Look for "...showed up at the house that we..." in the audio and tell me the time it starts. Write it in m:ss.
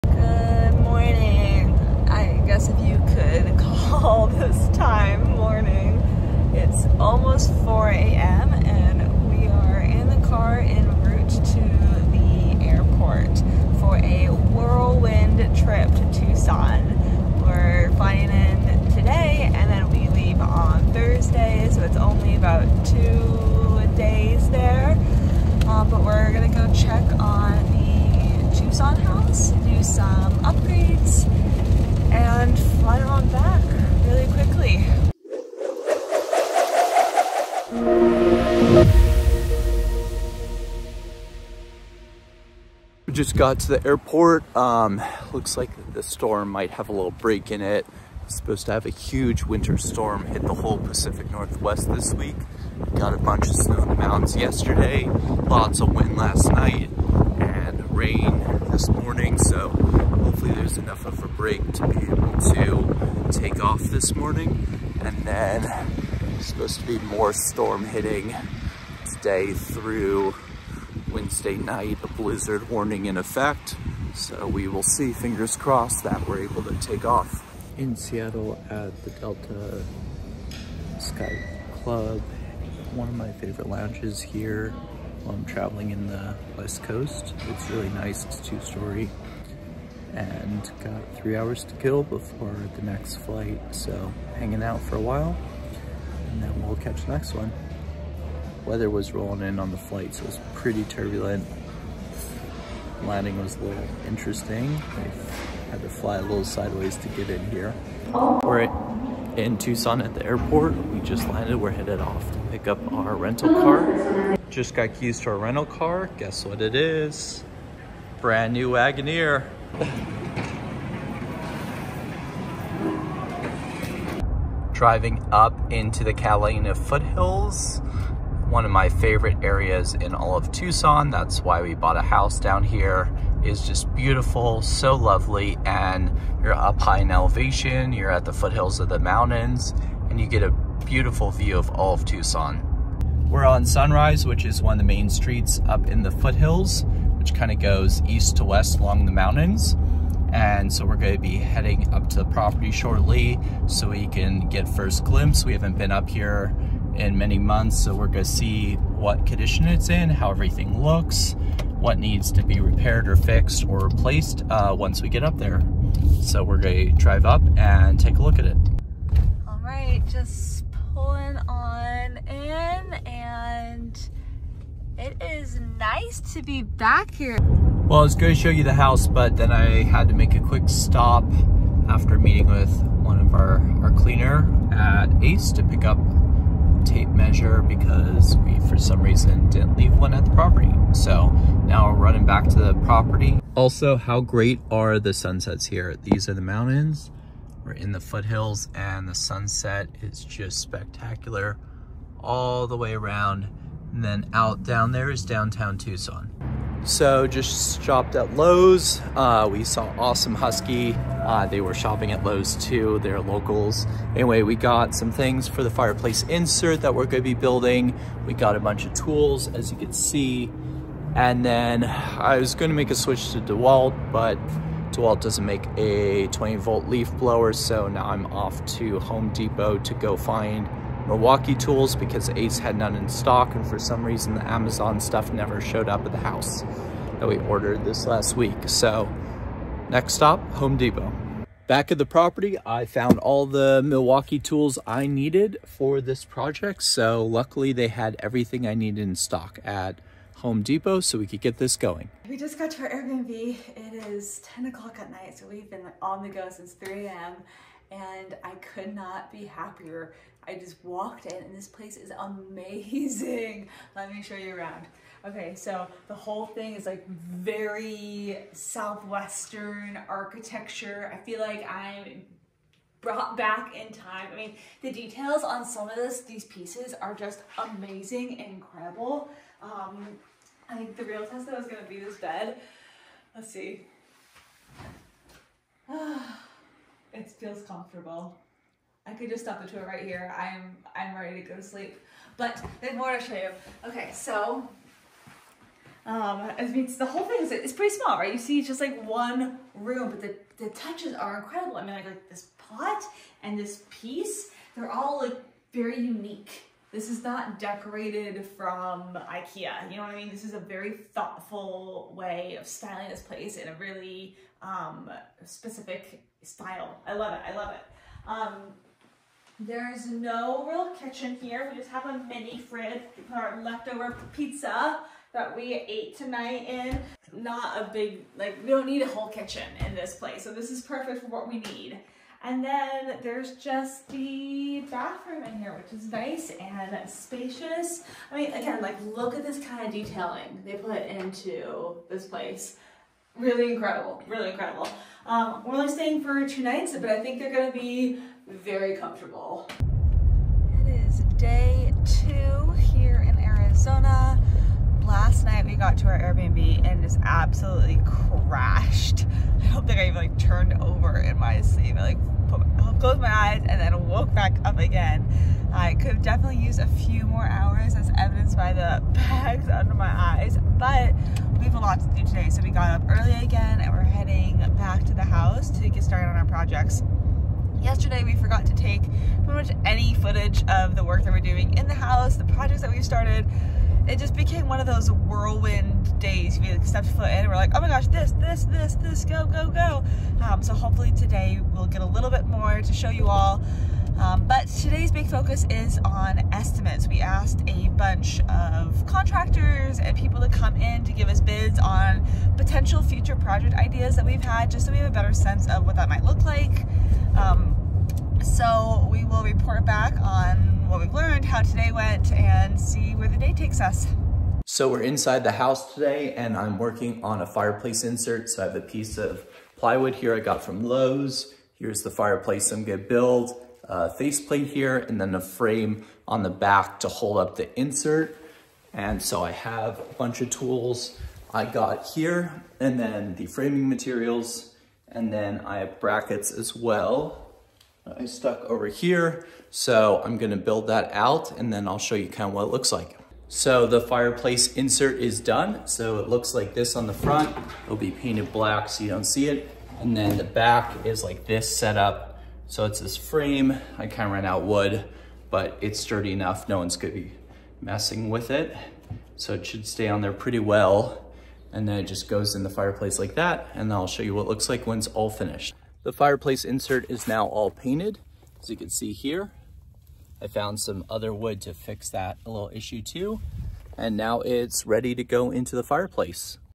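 3:55.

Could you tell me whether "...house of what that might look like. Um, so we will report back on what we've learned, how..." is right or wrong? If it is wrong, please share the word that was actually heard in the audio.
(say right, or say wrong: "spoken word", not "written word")
wrong: "sense", not "house".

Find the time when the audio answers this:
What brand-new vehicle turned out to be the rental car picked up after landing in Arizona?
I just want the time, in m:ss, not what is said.
1:58.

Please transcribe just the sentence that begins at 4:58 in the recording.
You see just like one room, but the, the touches are incredible.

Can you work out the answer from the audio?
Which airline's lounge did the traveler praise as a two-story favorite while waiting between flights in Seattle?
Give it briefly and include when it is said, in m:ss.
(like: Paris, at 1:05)
Delta Sky Club, at 1:19.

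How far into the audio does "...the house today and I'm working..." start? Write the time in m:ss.
6:55.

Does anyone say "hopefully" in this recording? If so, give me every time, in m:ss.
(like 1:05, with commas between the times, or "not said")
1:00, 6:30.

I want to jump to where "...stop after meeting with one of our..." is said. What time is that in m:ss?
3:00.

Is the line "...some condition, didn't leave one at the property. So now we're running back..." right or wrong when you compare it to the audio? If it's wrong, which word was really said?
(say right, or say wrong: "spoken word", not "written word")
wrong: "reason", not "condition".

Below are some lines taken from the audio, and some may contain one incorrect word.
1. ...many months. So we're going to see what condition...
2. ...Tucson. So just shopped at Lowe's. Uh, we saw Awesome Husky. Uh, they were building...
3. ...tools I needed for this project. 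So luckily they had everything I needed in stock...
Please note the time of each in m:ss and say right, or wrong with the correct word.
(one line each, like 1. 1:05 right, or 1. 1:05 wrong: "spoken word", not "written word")
1. 2:37 right
2. 3:25 wrong: "shopping", not "building"
3. 4:04 right.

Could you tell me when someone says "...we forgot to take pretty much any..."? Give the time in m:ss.
6:18.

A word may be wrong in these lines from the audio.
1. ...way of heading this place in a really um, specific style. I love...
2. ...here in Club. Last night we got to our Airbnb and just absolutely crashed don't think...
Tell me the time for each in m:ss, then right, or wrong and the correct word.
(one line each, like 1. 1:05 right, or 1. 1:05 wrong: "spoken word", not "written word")
1. 5:12 wrong: "styling", not "heading"
2. 5:52 wrong: "Arizona", not "Club".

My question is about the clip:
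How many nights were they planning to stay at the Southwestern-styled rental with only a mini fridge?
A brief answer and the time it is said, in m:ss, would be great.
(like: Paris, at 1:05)
2, at 5:46.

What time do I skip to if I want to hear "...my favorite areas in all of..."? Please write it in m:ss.
2:08.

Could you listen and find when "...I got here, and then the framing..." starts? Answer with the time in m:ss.
7:11.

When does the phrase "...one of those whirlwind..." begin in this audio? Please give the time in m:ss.
6:24.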